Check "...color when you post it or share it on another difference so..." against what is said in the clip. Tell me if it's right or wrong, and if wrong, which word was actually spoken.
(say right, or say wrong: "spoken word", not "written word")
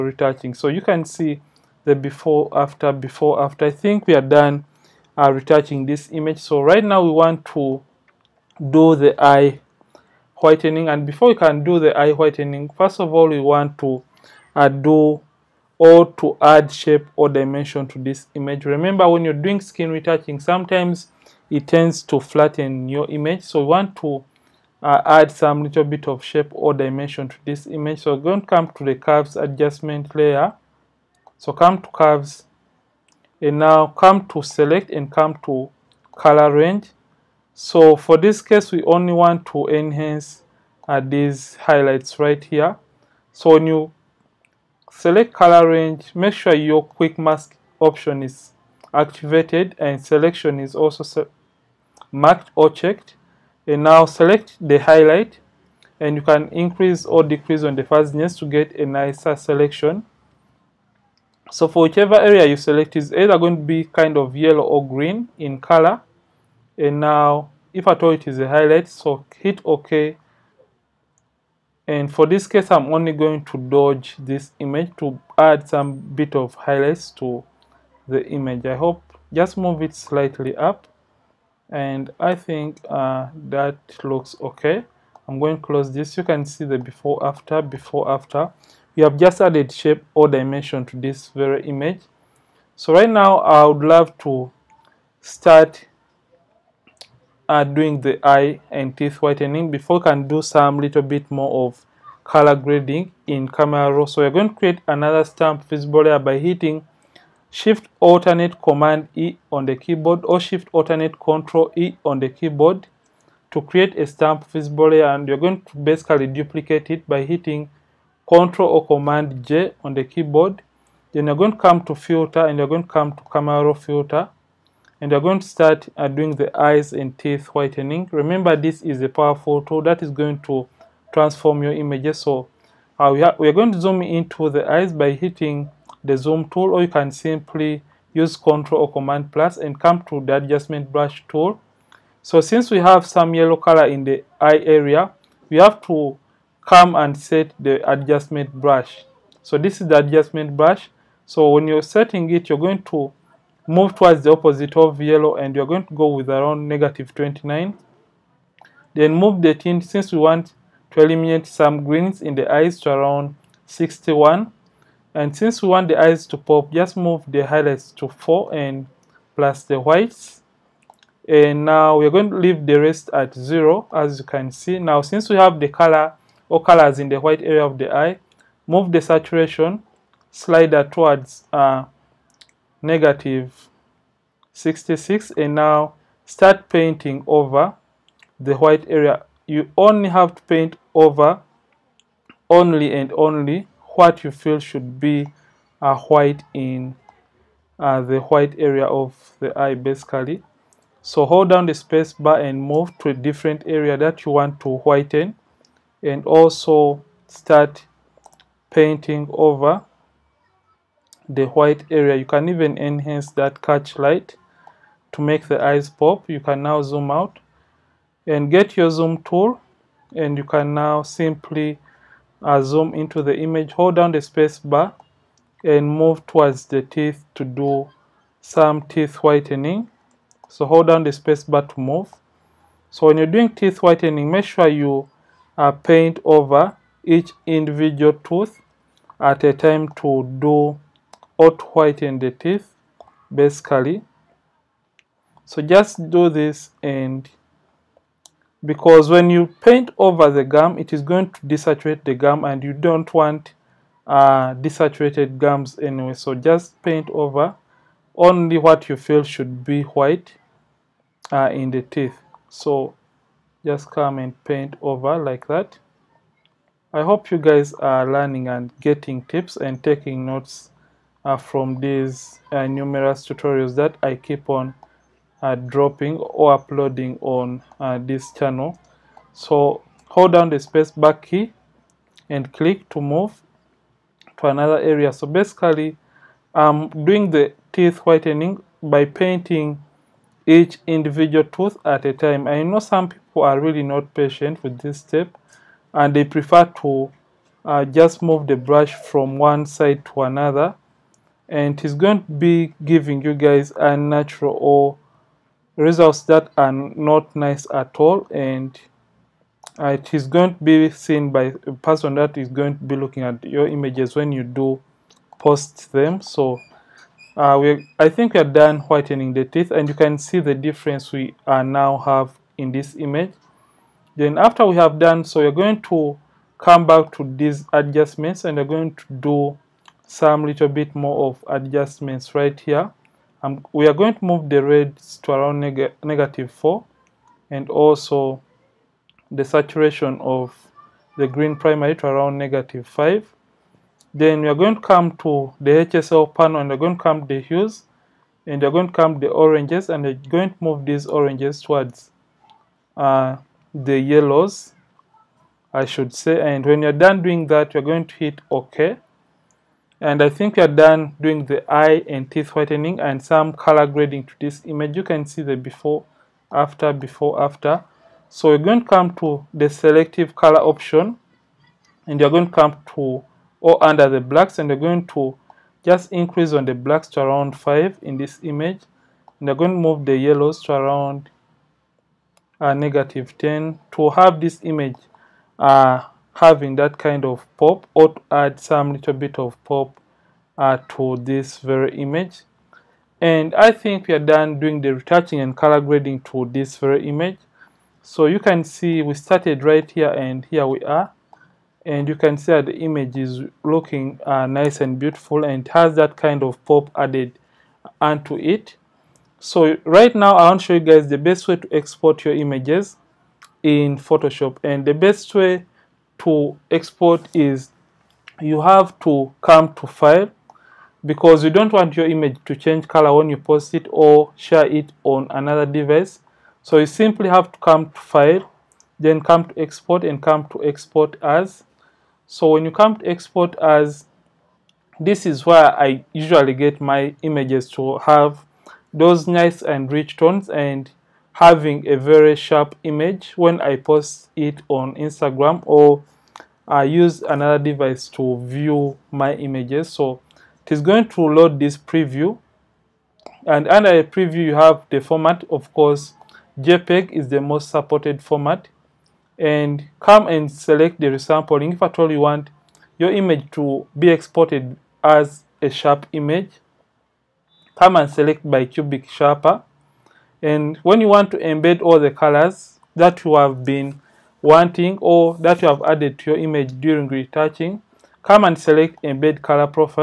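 wrong: "device", not "difference".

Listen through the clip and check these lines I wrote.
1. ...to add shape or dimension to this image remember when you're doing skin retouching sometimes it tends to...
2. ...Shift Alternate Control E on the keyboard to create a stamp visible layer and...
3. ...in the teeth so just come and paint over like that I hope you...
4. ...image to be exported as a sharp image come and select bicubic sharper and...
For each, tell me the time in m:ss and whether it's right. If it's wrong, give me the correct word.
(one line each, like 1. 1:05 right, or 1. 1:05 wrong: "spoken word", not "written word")
1. 0:16 right
2. 1:50 right
3. 4:21 right
4. 7:43 right.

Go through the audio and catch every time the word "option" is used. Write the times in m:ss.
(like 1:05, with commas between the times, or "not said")
0:47, 6:10.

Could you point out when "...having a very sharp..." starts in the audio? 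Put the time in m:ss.
7:21.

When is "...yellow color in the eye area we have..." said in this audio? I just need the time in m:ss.
2:23.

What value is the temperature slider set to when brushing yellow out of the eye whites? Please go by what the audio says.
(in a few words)
-29.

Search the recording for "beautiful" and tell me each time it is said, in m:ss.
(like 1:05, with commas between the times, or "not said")
6:44.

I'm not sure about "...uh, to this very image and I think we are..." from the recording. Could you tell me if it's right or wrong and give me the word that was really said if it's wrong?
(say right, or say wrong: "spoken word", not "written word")
right.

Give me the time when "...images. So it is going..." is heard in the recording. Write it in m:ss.
7:29.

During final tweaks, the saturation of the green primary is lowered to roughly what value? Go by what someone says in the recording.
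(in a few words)
-5.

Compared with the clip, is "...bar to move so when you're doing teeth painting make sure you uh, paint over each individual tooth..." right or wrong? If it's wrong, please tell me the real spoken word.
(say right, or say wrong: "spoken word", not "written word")
wrong: "whitening", not "painting".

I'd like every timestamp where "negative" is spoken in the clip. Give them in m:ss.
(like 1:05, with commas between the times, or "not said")
2:36, 3:02, 5:36, 5:42.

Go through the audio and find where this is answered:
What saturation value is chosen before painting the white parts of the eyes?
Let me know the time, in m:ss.
3:02.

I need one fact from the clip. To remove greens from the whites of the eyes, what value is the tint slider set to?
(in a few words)
61.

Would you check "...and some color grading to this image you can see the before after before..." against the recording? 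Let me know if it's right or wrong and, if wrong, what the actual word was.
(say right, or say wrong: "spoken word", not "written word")
right.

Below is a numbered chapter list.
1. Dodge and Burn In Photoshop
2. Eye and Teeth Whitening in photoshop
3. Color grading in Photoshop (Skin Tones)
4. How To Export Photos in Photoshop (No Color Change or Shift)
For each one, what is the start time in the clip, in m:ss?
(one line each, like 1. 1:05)
1. 0:17
2. 1:46
3. 5:27
4. 6:50.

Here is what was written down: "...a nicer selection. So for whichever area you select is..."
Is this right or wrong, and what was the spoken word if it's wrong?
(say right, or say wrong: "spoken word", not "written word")
right.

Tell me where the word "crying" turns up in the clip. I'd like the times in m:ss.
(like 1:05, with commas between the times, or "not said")
not said.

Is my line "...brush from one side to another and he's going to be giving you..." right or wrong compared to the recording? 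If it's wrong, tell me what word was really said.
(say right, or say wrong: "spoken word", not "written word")
right.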